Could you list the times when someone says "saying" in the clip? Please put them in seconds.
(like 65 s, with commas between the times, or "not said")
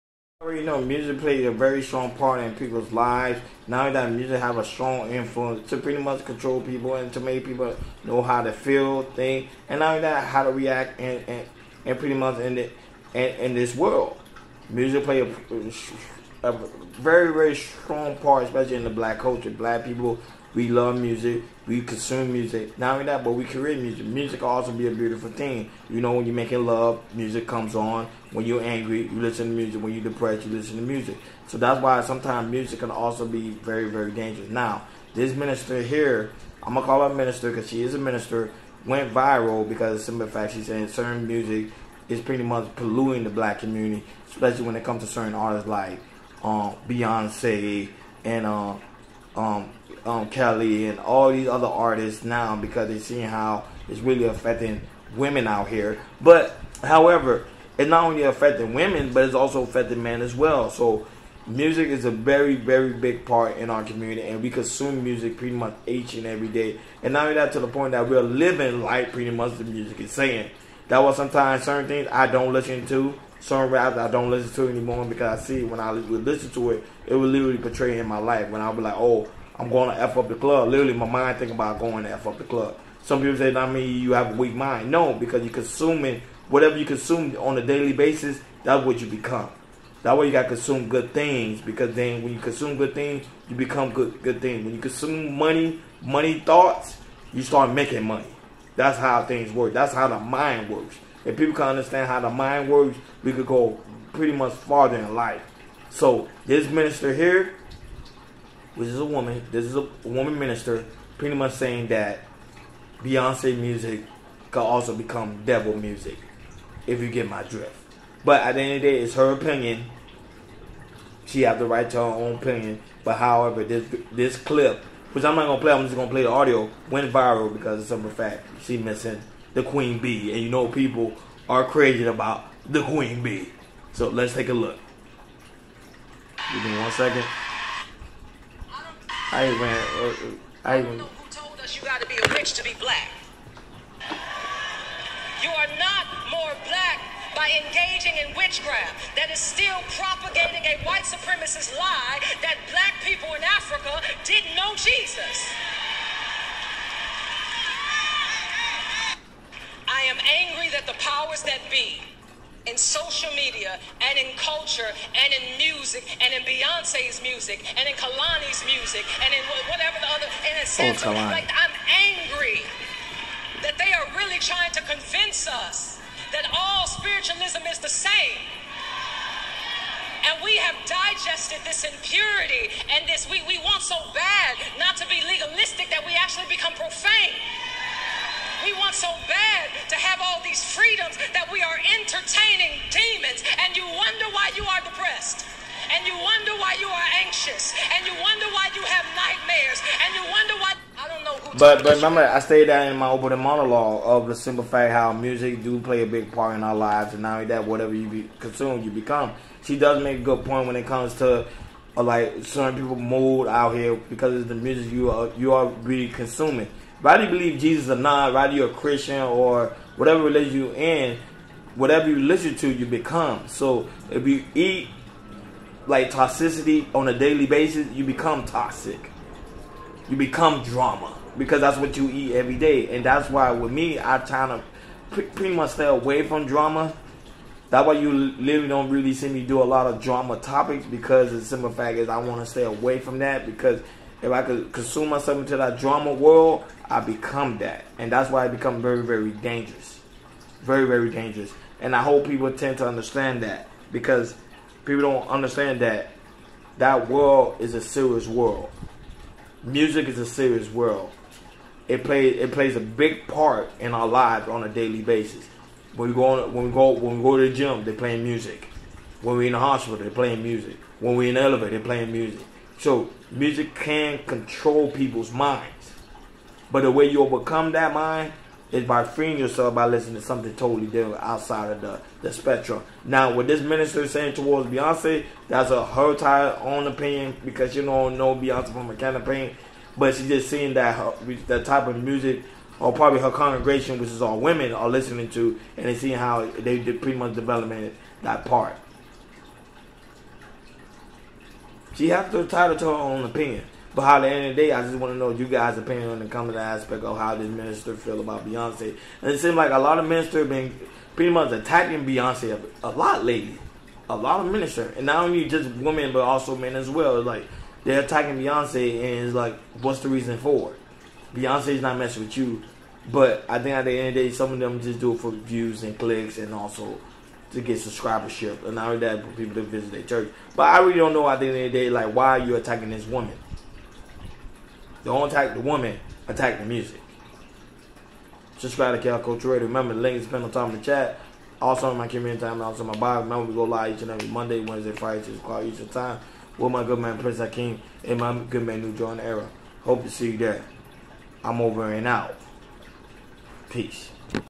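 40 s, 70 s, 111 s, 284 s.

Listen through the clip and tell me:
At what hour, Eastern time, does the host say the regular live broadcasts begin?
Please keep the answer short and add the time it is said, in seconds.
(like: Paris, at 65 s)
6 o'clock, at 345 s.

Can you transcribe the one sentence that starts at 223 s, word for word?
So if you eat like toxicity on a daily basis, you become toxic.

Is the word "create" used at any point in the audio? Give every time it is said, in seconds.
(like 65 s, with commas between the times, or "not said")
23 s.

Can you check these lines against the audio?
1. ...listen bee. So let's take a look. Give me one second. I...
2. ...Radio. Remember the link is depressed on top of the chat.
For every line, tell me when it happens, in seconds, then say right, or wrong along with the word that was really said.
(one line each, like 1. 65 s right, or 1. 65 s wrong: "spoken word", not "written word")
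1. 132 s wrong: "queen", not "listen"
2. 339 s wrong: "pinned", not "depressed".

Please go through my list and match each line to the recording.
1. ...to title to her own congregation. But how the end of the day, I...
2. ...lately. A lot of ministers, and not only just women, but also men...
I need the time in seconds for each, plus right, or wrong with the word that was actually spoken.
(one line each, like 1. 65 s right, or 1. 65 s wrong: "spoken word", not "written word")
1. 302 s wrong: "opinion", not "congregation"
2. 313 s right.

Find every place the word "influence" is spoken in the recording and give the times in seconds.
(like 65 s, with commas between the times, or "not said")
5 s.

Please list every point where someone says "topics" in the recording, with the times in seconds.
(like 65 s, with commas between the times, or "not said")
240 s.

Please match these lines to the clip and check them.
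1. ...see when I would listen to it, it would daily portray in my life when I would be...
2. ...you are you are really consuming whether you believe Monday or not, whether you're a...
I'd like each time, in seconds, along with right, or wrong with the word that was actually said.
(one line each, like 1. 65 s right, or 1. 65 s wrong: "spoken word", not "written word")
1. 75 s wrong: "literally", not "daily"
2. 214 s wrong: "Jesus", not "Monday".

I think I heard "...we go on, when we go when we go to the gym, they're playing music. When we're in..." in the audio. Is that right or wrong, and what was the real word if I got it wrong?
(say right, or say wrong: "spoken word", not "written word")
right.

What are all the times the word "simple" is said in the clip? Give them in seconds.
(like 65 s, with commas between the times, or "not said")
40 s, 204 s, 241 s.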